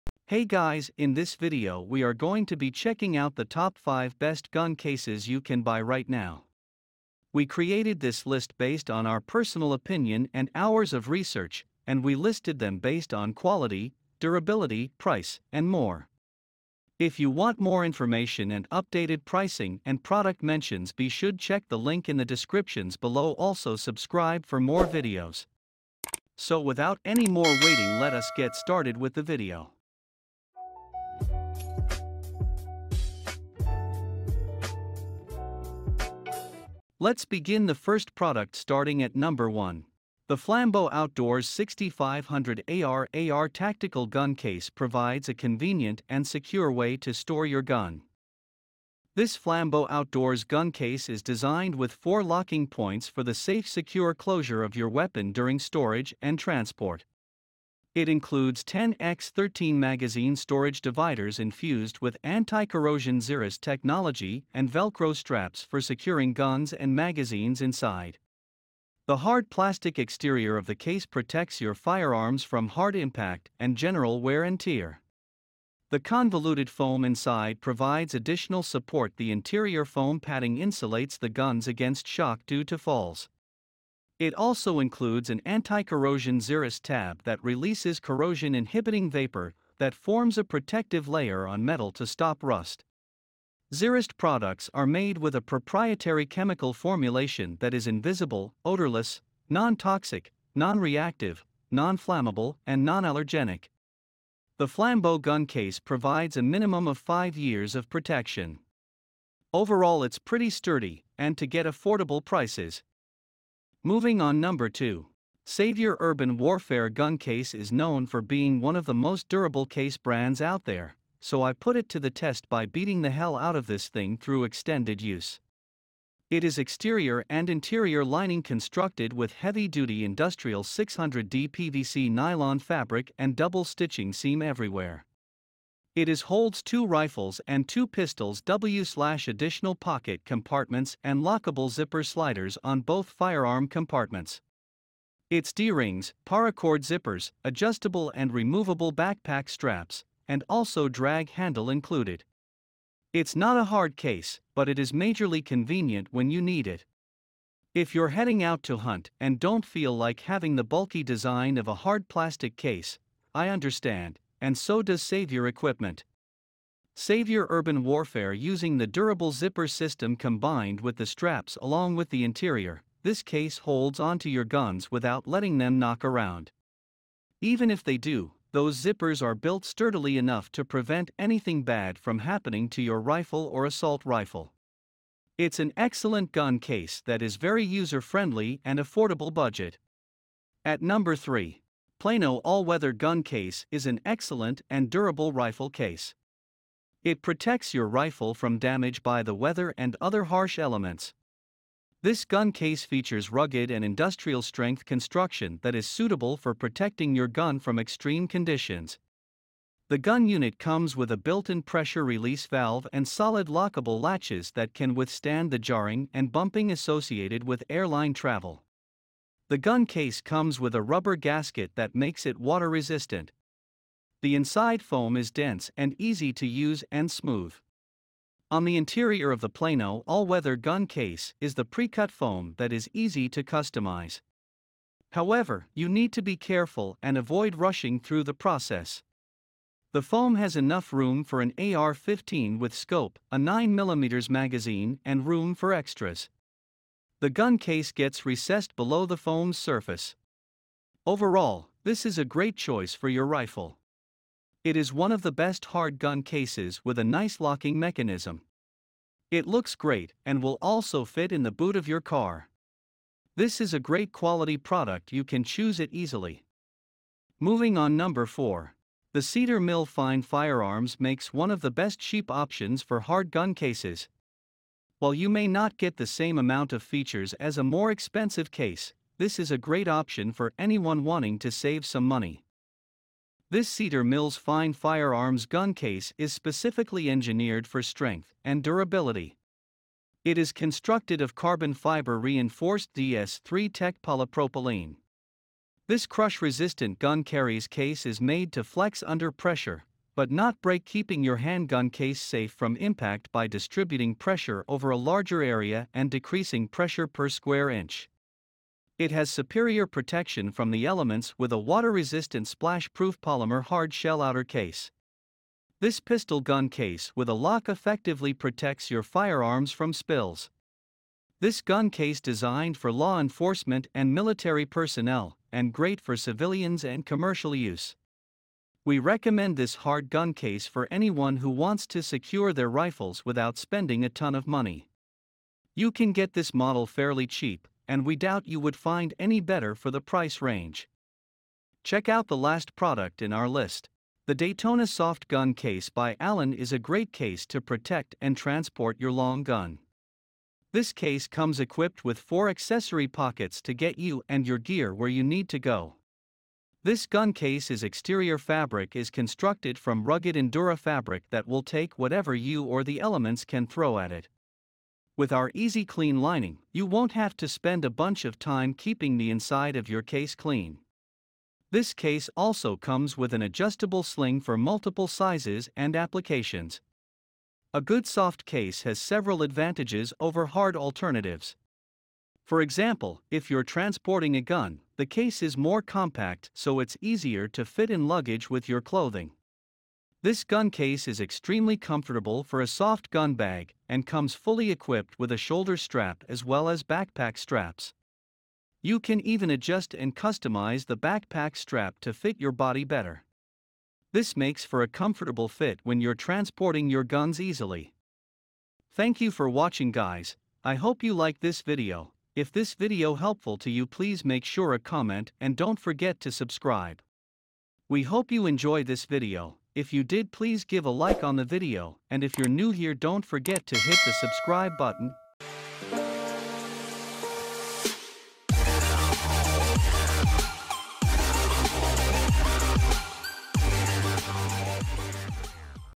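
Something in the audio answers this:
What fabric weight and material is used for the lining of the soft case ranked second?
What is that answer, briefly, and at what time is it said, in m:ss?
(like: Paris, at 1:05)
600D PVC nylon, at 2:10.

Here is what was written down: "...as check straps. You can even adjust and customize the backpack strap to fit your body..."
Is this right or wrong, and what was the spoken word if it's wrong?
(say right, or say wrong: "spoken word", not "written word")
wrong: "backpack", not "check".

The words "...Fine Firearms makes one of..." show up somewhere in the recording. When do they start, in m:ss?
4:29.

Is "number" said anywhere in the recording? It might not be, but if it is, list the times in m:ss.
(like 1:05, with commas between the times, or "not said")
0:39, 1:54, 3:10, 4:27.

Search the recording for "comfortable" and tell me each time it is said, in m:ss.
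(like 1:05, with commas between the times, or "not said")
6:31, 6:44.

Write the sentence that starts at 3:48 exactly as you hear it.
On the interior of the Plano all weather gun case is the pre cut foam that is easy to customize.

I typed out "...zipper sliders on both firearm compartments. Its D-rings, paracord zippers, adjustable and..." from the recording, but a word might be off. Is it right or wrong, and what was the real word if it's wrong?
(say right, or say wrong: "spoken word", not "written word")
right.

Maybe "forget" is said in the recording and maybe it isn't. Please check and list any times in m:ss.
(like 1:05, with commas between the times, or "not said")
6:55, 7:03.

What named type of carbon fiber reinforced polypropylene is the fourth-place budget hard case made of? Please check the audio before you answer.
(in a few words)
DS3 Tech.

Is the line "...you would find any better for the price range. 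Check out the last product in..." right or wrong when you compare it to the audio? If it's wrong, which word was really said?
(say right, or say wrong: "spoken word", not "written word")
right.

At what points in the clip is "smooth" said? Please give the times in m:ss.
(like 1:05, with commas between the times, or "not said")
3:47.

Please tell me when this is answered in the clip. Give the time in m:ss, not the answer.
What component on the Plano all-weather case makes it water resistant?
3:40.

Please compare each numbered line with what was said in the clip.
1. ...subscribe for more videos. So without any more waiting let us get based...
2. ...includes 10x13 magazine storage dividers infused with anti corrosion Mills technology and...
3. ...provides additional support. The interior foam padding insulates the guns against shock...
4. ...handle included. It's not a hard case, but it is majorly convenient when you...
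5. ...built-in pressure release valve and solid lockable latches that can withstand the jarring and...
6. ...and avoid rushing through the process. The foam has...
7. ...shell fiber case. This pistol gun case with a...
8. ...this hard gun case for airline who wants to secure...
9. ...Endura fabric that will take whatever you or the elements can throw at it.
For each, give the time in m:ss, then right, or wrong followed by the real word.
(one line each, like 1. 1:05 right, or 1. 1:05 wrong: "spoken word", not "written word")
1. 0:23 wrong: "started", not "based"
2. 0:58 wrong: "Zerust", not "Mills"
3. 1:17 right
4. 2:31 right
5. 3:31 right
6. 3:57 right
7. 5:13 wrong: "outer", not "fiber"
8. 5:29 wrong: "anyone", not "airline"
9. 6:00 right.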